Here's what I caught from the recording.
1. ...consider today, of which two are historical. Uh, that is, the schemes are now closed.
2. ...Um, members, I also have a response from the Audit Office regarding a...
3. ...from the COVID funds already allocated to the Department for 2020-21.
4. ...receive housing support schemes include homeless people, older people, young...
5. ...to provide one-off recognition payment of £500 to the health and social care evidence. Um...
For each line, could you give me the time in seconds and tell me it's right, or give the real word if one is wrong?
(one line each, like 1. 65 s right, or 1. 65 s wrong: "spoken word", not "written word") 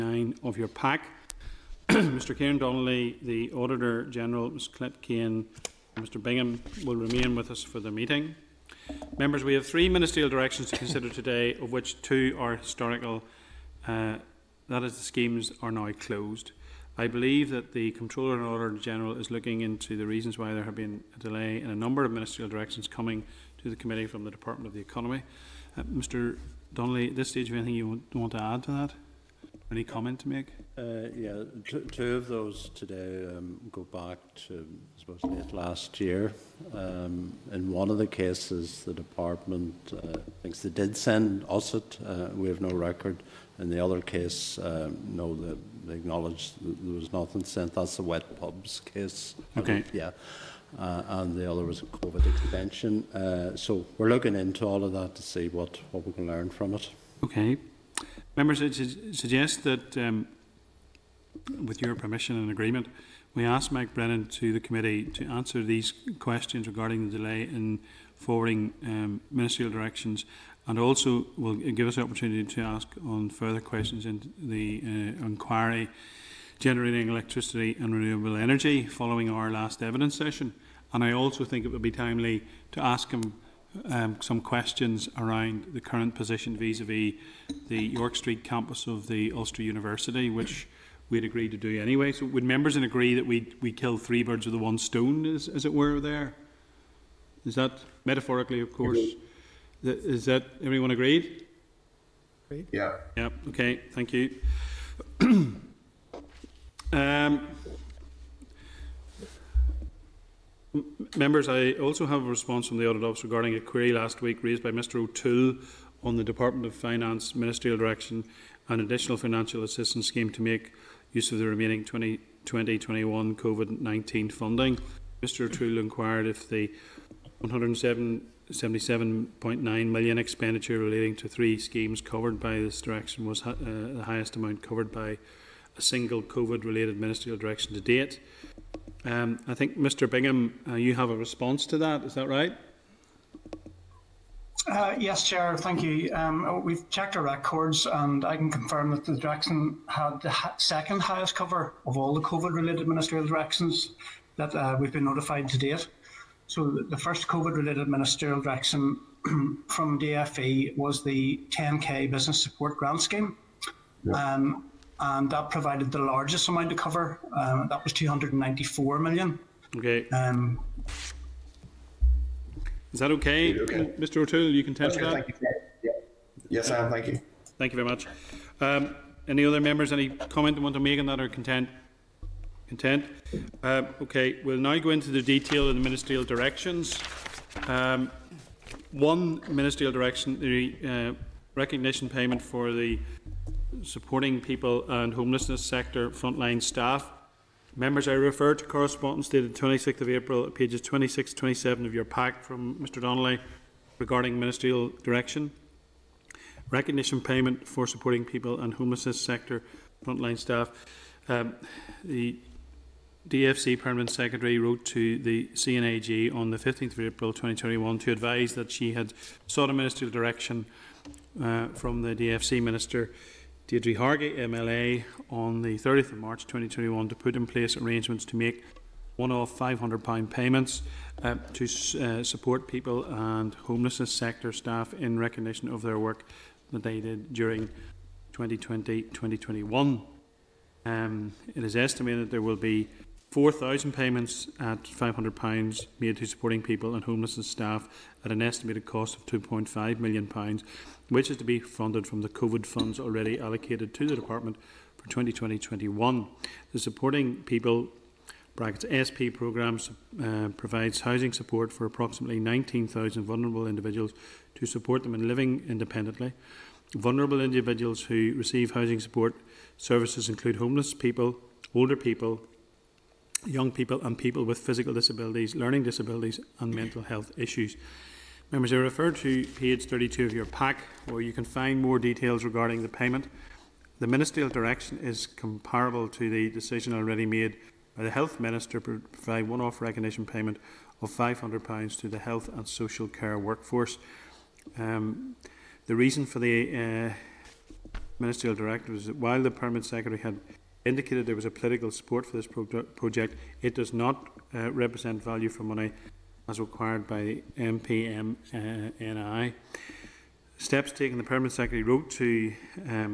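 1. 10 s right
2. 106 s right
3. 252 s right
4. 268 s wrong: "services", not "schemes"
5. 288 s wrong: "workforce", not "evidence".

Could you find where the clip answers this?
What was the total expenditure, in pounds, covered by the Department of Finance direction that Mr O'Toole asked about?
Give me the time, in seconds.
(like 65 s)
127 s.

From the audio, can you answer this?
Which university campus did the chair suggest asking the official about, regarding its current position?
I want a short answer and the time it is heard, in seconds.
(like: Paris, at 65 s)
York Street, at 87 s.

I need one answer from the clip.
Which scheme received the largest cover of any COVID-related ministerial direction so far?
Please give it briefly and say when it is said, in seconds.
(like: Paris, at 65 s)
10K Business Support Grant Scheme, at 161 s.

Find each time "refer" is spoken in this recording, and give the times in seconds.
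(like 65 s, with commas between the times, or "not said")
198 s, 278 s.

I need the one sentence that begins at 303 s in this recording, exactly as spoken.
It does not uh, represent value for money as required by MPMNI.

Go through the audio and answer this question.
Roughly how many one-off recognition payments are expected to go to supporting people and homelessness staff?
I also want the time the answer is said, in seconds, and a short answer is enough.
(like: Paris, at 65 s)
4,000, at 243 s.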